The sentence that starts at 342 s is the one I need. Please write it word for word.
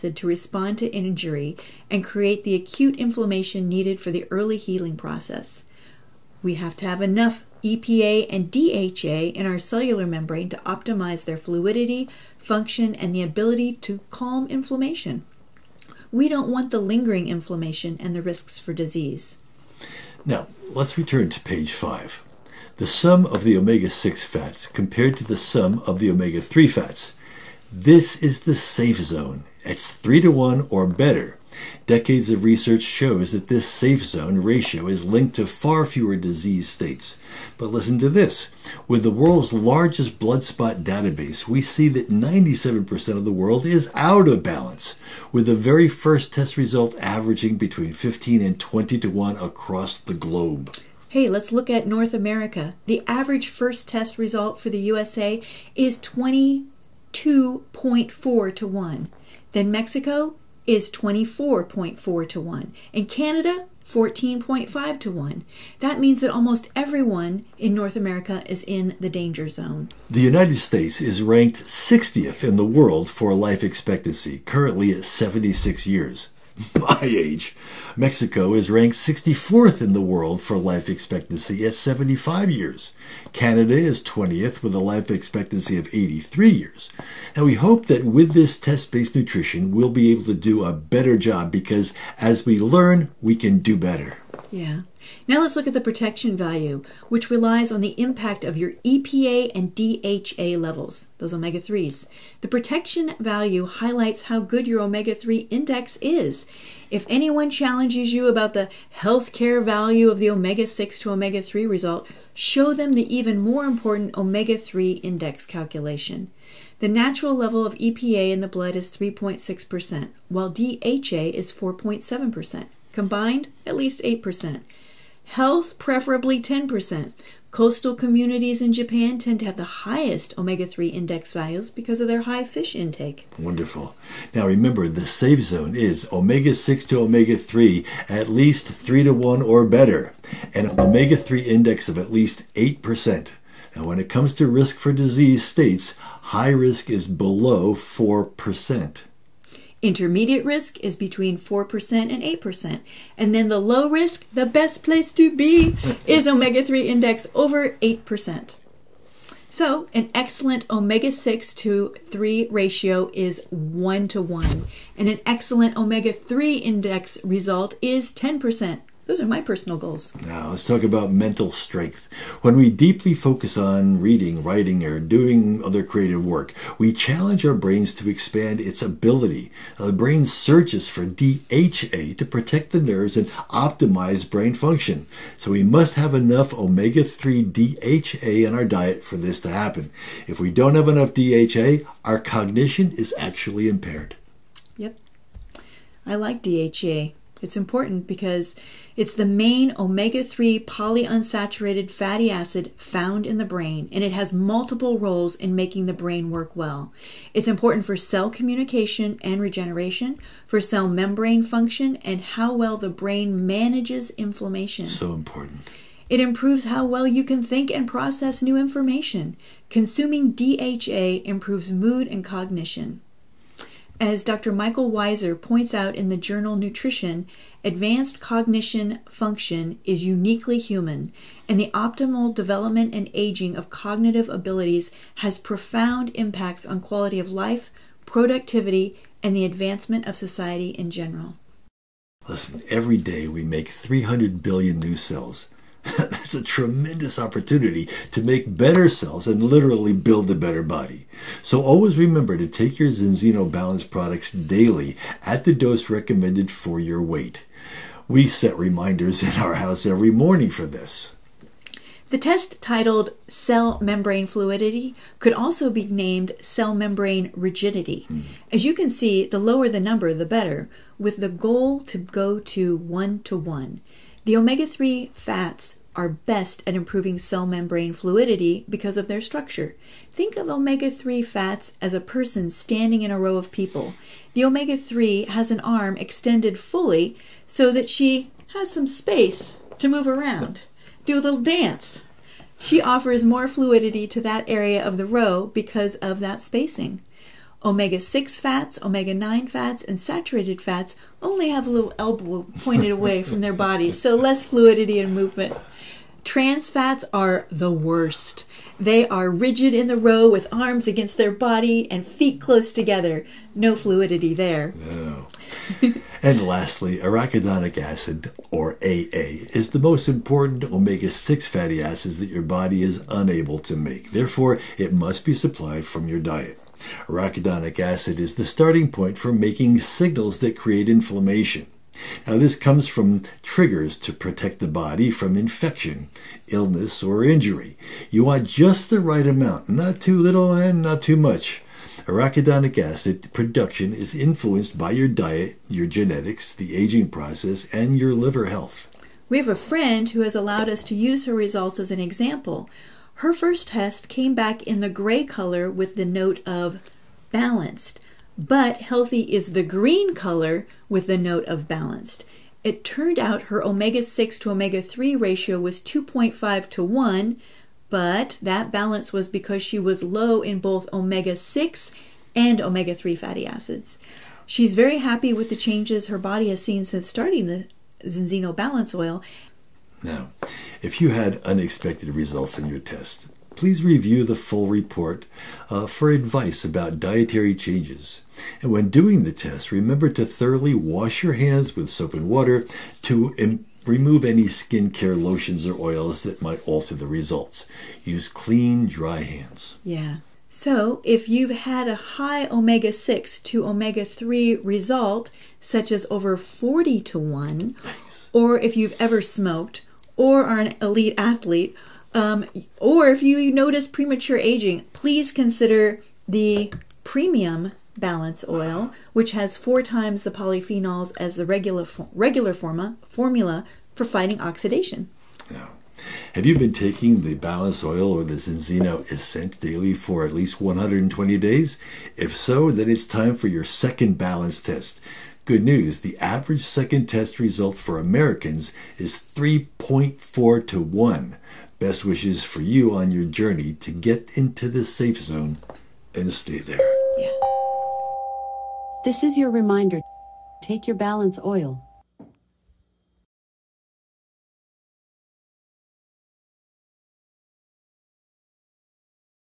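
Arachidonic acid production is influenced by your diet, your genetics, the aging process, and your liver health.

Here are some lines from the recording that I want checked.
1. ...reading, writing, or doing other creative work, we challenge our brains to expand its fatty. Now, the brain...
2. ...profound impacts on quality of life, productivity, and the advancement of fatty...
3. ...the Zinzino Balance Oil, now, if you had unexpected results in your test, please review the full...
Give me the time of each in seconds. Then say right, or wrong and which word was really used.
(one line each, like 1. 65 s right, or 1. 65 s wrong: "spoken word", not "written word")
1. 174 s wrong: "ability", not "fatty"
2. 235 s wrong: "society", not "fatty"
3. 377 s right.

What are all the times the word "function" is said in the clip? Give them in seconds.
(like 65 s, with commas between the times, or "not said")
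12 s, 184 s, 211 s, 229 s.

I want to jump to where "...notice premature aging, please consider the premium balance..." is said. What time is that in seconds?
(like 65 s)
413 s.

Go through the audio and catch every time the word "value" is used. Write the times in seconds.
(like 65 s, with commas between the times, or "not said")
96 s, 103 s, 109 s, 131 s.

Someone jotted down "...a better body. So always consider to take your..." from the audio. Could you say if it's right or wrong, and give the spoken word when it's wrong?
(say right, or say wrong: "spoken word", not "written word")
wrong: "remember", not "consider".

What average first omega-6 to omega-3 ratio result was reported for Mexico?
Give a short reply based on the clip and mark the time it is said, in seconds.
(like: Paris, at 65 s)
24.4 to 1, at 60 s.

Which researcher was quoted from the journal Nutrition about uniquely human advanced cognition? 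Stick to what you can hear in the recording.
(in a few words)
Michael Weiser.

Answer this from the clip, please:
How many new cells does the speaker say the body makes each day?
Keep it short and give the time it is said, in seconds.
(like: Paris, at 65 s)
300 billion, at 243 s.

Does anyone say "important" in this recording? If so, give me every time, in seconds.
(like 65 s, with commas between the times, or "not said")
113 s, 197 s, 207 s, 215 s, 320 s.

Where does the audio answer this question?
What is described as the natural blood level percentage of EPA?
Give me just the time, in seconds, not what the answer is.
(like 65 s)
118 s.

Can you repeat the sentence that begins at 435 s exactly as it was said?
Good news the average second test result for Americans is 3.4 to 1.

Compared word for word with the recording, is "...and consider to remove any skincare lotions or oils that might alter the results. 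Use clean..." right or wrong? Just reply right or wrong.
wrong.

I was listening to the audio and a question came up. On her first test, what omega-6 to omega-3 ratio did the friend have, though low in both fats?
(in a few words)
2.5 to 1.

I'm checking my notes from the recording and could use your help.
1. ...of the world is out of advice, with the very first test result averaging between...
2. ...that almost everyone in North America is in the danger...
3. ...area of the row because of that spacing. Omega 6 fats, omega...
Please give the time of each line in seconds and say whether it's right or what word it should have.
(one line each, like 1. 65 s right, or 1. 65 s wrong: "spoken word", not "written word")
1. 43 s wrong: "balance", not "advice"
2. 66 s right
3. 294 s right.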